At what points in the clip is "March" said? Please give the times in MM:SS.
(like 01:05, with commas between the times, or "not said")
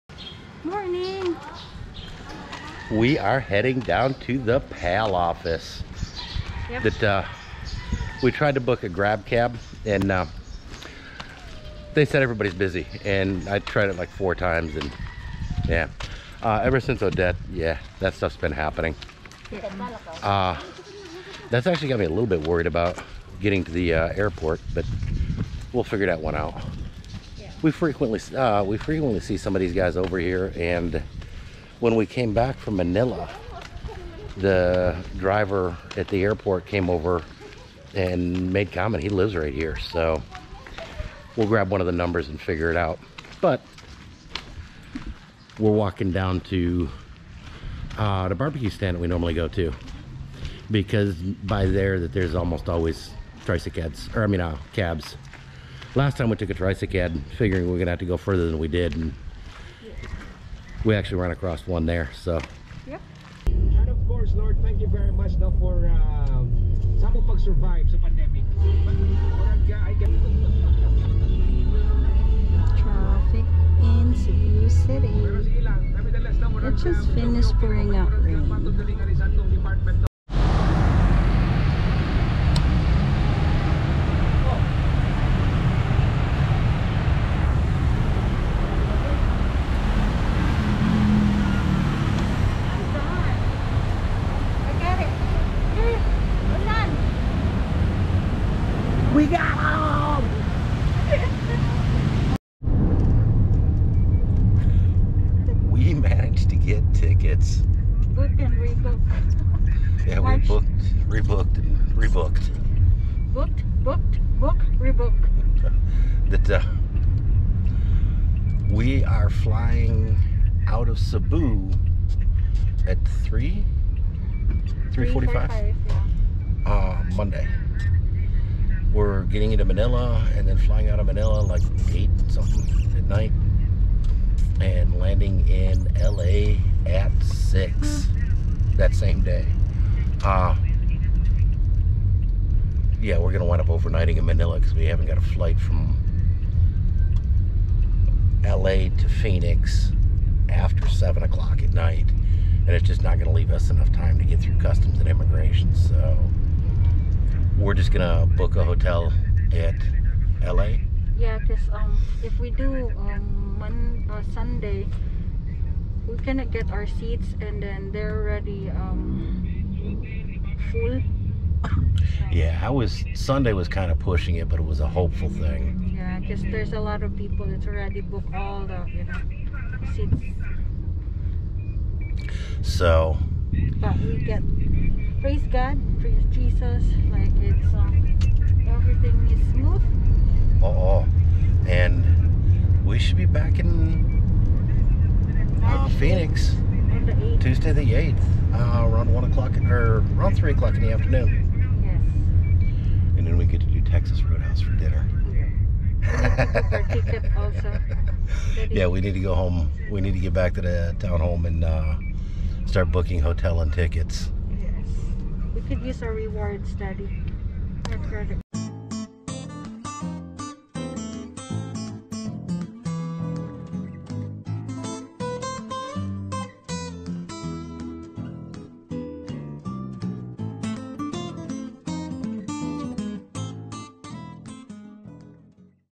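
01:50.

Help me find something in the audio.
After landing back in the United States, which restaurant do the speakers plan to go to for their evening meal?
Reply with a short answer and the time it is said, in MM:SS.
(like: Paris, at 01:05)
Texas Roadhouse, at 03:23.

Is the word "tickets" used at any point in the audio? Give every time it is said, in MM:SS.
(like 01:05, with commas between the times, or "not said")
01:46, 03:33.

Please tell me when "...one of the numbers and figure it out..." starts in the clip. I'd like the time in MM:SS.
00:41.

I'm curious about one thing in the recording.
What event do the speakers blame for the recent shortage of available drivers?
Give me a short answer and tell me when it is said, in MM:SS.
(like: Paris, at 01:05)
Odette, at 00:17.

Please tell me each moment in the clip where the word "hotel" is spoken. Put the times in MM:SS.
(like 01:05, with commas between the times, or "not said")
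02:38, 03:33.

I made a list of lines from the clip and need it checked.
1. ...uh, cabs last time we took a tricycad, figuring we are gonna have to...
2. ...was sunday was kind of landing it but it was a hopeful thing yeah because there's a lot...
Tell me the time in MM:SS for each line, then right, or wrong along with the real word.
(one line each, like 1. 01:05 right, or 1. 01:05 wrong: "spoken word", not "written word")
1. 00:54 right
2. 02:52 wrong: "pushing", not "landing".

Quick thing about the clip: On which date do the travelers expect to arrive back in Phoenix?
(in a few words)
Tuesday the 8th.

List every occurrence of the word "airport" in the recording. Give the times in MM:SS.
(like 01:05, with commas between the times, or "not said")
00:24, 00:36.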